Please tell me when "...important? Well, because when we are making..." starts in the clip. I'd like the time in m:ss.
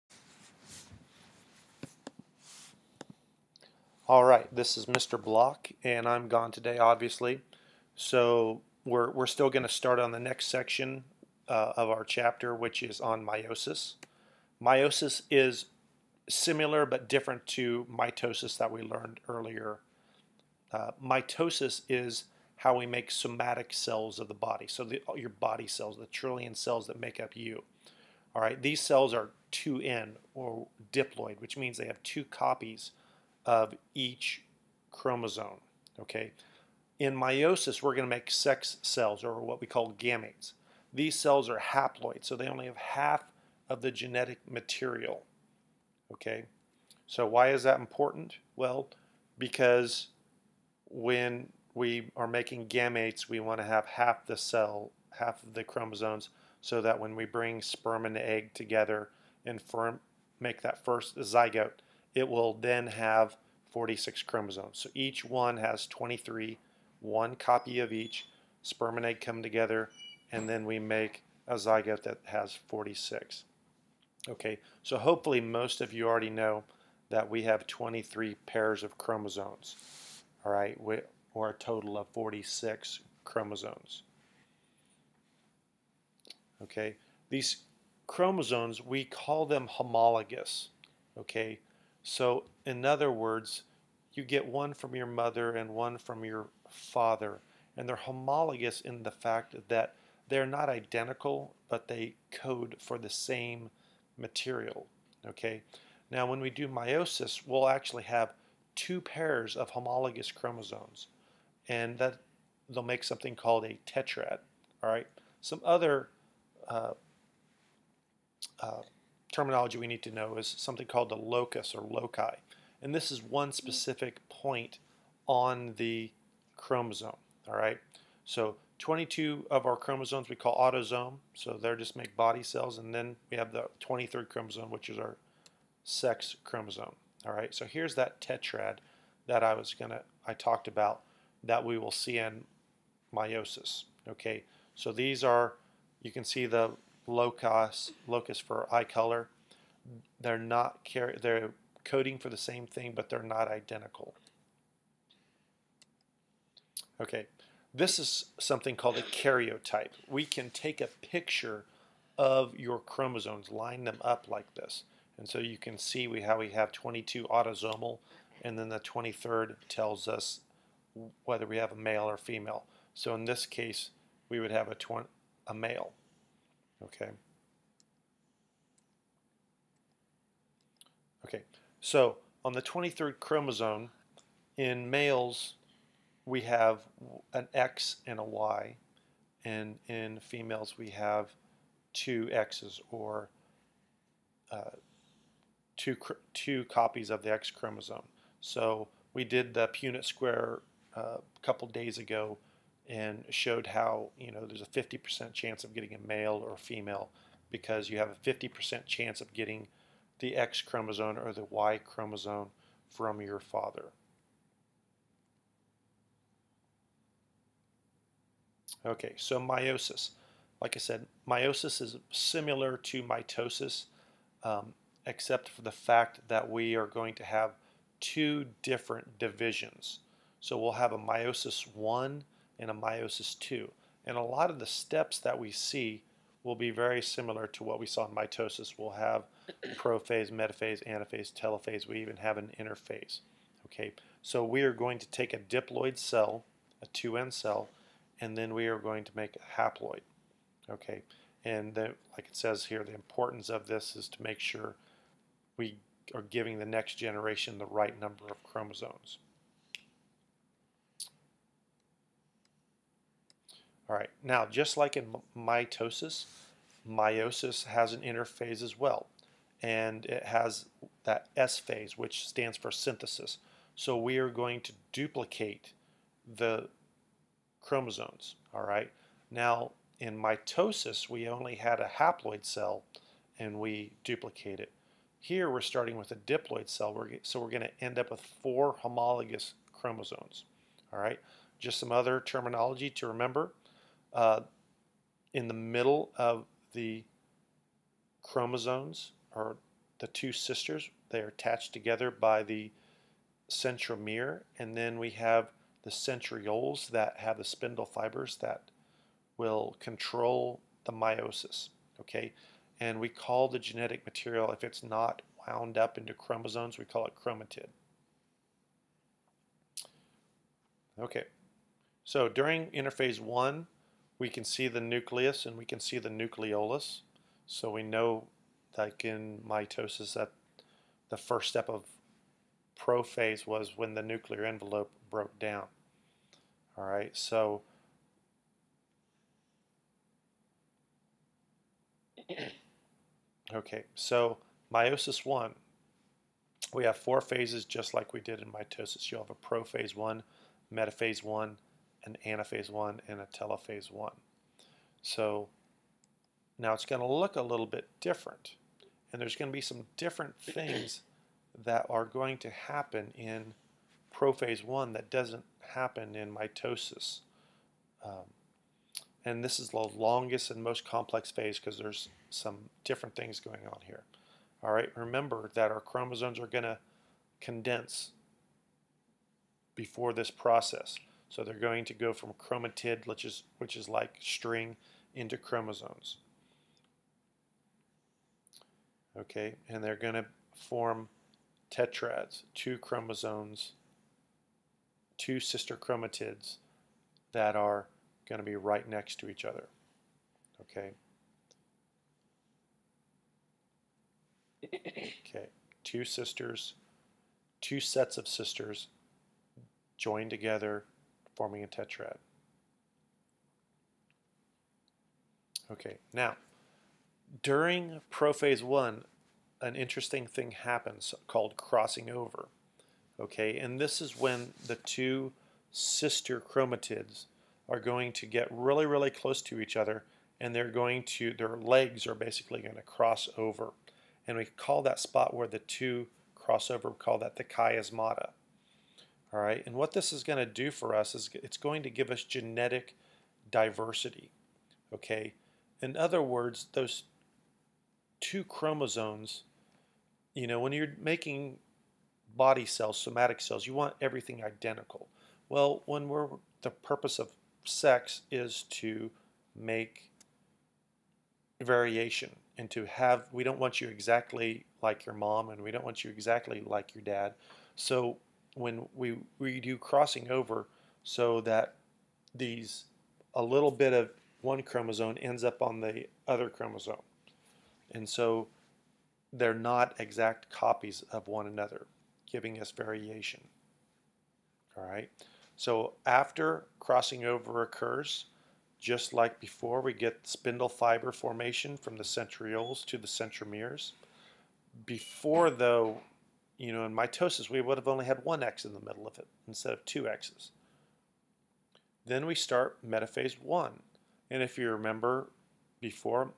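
0:47.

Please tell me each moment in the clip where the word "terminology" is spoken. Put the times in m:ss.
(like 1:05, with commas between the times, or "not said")
1:59, 4:52.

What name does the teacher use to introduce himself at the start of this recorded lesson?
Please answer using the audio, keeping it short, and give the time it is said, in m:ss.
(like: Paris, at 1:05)
Mr. Block, at 0:04.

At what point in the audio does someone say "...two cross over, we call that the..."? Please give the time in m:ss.
7:15.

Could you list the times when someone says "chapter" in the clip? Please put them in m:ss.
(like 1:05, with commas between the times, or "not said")
0:12.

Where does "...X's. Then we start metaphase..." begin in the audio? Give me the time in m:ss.
8:20.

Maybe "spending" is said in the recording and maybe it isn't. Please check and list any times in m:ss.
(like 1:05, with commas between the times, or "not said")
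not said.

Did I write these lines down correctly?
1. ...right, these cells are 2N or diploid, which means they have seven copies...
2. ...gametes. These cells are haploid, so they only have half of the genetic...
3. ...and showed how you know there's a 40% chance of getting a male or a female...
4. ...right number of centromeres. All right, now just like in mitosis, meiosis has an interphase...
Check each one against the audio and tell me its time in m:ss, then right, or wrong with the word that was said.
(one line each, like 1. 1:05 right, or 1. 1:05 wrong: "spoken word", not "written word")
1. 0:28 wrong: "two", not "seven"
2. 0:39 right
3. 3:22 wrong: "50", not "40"
4. 4:17 wrong: "chromosomes", not "centromeres".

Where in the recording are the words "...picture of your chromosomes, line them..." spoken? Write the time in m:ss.
2:41.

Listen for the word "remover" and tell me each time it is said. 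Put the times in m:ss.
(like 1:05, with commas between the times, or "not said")
not said.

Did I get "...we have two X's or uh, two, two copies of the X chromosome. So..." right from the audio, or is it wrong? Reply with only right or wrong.
right.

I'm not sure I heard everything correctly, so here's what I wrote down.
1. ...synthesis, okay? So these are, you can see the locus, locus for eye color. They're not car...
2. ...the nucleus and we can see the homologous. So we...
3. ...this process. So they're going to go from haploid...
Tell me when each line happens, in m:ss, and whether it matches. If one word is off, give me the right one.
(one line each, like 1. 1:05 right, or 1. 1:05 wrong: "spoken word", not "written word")
1. 2:23 wrong: "meiosis", not "synthesis"
2. 5:24 wrong: "nucleolus", not "homologous"
3. 6:20 wrong: "chromatid", not "haploid".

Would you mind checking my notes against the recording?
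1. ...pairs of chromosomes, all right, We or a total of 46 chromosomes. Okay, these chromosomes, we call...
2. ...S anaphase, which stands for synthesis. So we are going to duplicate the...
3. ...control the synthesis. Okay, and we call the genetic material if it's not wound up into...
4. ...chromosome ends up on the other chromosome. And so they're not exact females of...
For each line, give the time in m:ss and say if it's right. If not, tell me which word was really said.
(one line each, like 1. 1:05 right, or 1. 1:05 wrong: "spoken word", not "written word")
1. 1:18 right
2. 4:31 wrong: "phase", not "anaphase"
3. 5:09 wrong: "meiosis", not "synthesis"
4. 7:54 wrong: "copies", not "females".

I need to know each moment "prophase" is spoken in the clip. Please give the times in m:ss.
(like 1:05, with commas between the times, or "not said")
3:59, 5:32, 5:49, 6:04, 6:58.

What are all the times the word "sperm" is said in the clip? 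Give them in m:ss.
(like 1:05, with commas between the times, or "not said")
0:57, 1:08.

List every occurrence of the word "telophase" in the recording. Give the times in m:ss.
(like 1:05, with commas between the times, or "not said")
4:01, 5:53.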